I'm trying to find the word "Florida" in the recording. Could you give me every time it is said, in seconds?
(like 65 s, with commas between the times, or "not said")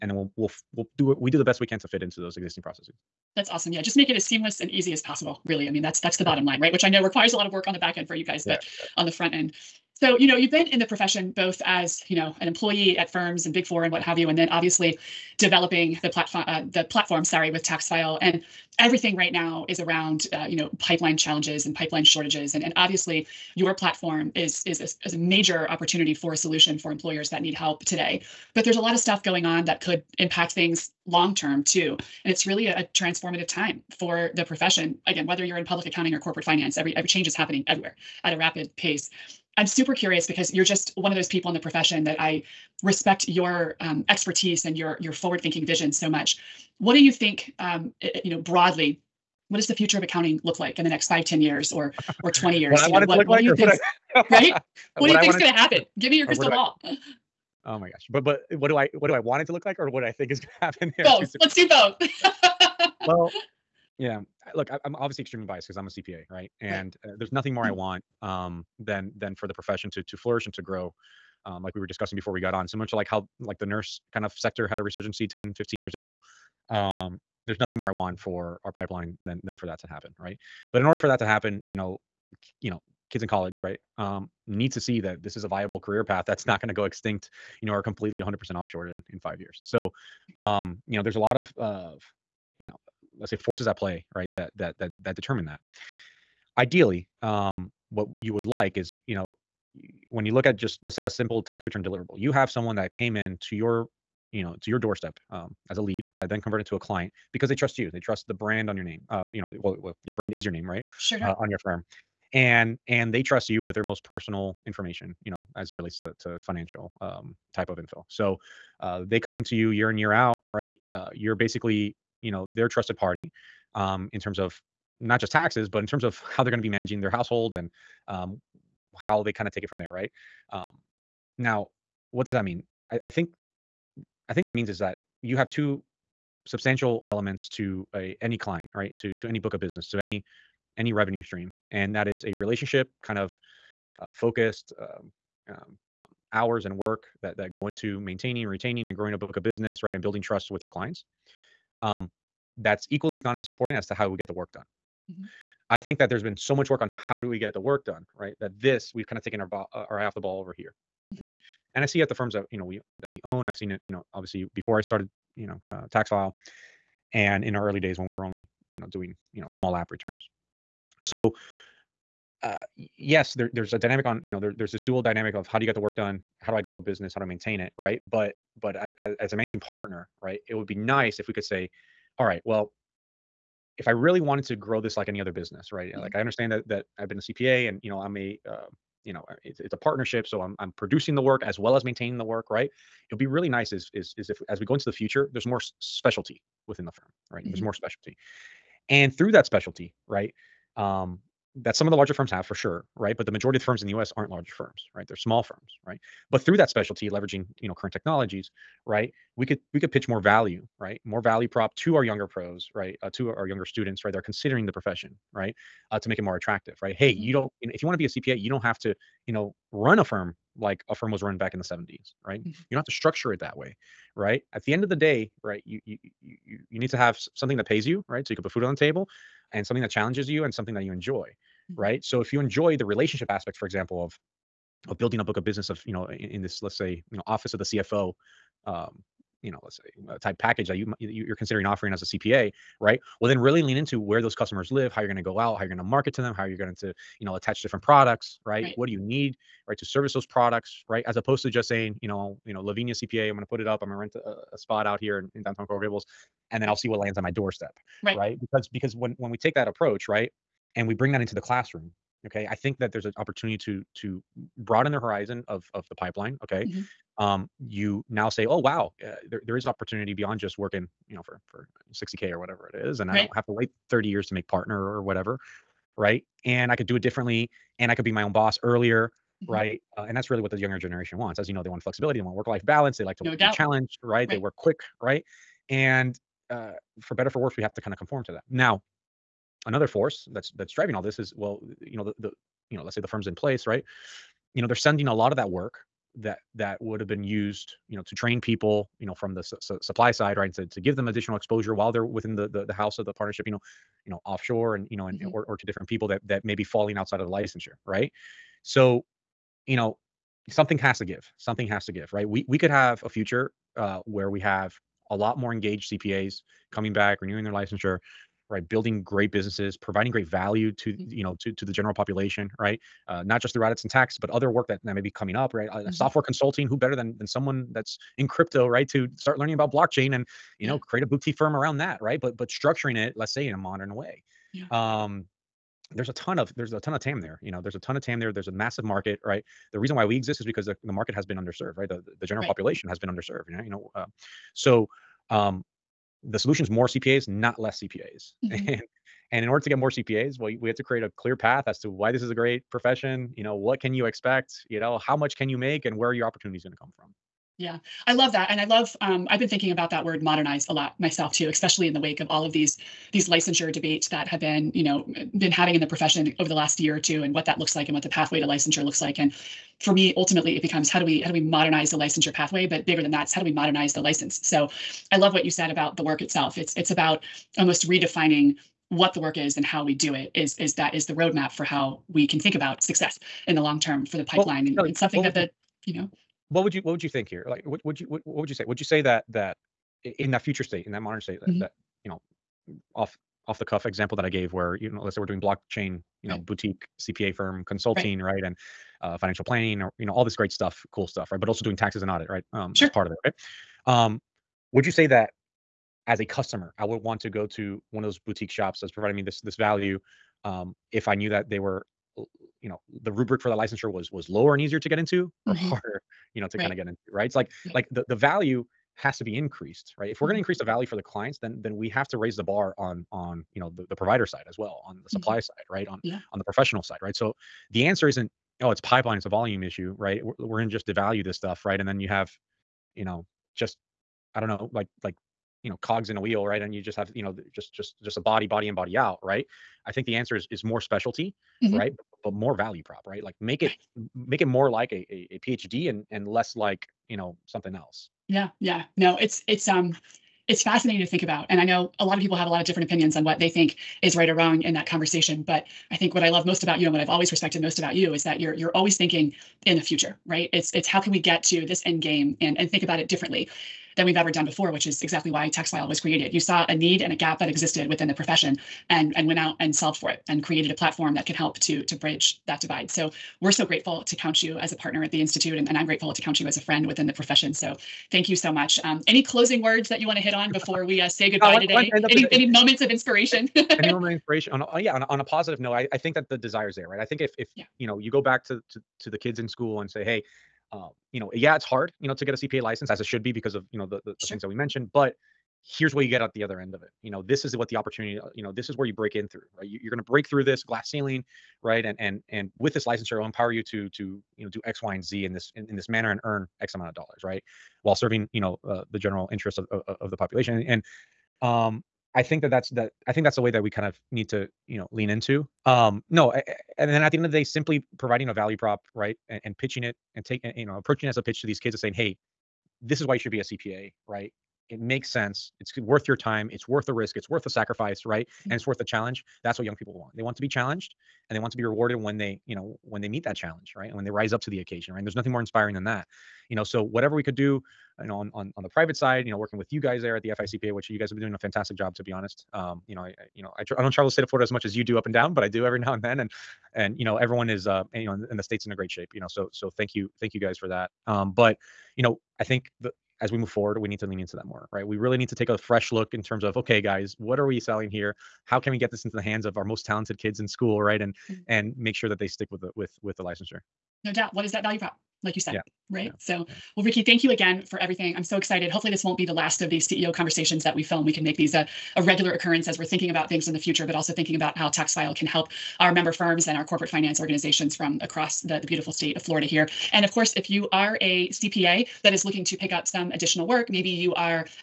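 544 s, 579 s.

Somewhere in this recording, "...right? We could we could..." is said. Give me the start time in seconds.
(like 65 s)
208 s.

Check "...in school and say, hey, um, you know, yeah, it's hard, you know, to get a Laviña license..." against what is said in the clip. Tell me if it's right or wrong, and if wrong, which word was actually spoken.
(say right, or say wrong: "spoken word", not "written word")
wrong: "CPA", not "Laviña".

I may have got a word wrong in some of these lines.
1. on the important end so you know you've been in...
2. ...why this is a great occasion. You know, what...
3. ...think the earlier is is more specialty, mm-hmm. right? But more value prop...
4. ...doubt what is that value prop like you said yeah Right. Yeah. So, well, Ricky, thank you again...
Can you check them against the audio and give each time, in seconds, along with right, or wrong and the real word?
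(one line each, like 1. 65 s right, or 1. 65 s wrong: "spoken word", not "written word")
1. 8 s wrong: "front", not "important"
2. 351 s wrong: "profession", not "occasion"
3. 439 s wrong: "answer", not "earlier"
4. 564 s right.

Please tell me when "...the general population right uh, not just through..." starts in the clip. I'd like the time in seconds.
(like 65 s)
321 s.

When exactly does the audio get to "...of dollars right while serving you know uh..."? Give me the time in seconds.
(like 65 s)
506 s.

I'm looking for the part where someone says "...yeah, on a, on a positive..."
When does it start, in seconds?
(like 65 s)
484 s.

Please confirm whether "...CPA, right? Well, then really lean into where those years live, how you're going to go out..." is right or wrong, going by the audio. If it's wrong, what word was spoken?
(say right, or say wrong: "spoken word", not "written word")
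wrong: "customers", not "years".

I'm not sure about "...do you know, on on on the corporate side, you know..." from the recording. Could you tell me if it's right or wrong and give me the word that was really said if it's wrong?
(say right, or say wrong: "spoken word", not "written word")
wrong: "private", not "corporate".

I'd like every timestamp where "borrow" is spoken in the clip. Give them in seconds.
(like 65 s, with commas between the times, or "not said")
not said.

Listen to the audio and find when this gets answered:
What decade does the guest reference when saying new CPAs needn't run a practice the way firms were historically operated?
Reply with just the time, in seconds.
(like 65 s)
221 s.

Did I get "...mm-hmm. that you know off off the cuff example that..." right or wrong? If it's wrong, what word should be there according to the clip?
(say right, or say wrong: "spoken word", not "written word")
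right.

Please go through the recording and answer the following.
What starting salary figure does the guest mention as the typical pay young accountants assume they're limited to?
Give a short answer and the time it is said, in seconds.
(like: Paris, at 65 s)
60k, at 271 s.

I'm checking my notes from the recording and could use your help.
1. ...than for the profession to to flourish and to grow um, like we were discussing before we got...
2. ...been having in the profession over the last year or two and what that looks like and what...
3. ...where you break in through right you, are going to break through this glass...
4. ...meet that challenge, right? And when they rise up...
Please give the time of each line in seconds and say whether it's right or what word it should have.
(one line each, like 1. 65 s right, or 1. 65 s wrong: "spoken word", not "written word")
1. 69 s right
2. 365 s right
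3. 498 s right
4. 533 s right.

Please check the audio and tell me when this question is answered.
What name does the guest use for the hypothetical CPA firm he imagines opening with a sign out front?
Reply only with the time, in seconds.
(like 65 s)
252 s.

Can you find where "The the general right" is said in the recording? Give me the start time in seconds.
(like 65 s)
341 s.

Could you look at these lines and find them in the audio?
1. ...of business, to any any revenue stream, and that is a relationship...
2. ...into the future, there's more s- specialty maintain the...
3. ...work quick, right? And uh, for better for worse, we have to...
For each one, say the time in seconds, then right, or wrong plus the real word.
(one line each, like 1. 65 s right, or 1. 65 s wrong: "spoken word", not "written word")
1. 139 s right
2. 194 s wrong: "within", not "maintain"
3. 284 s right.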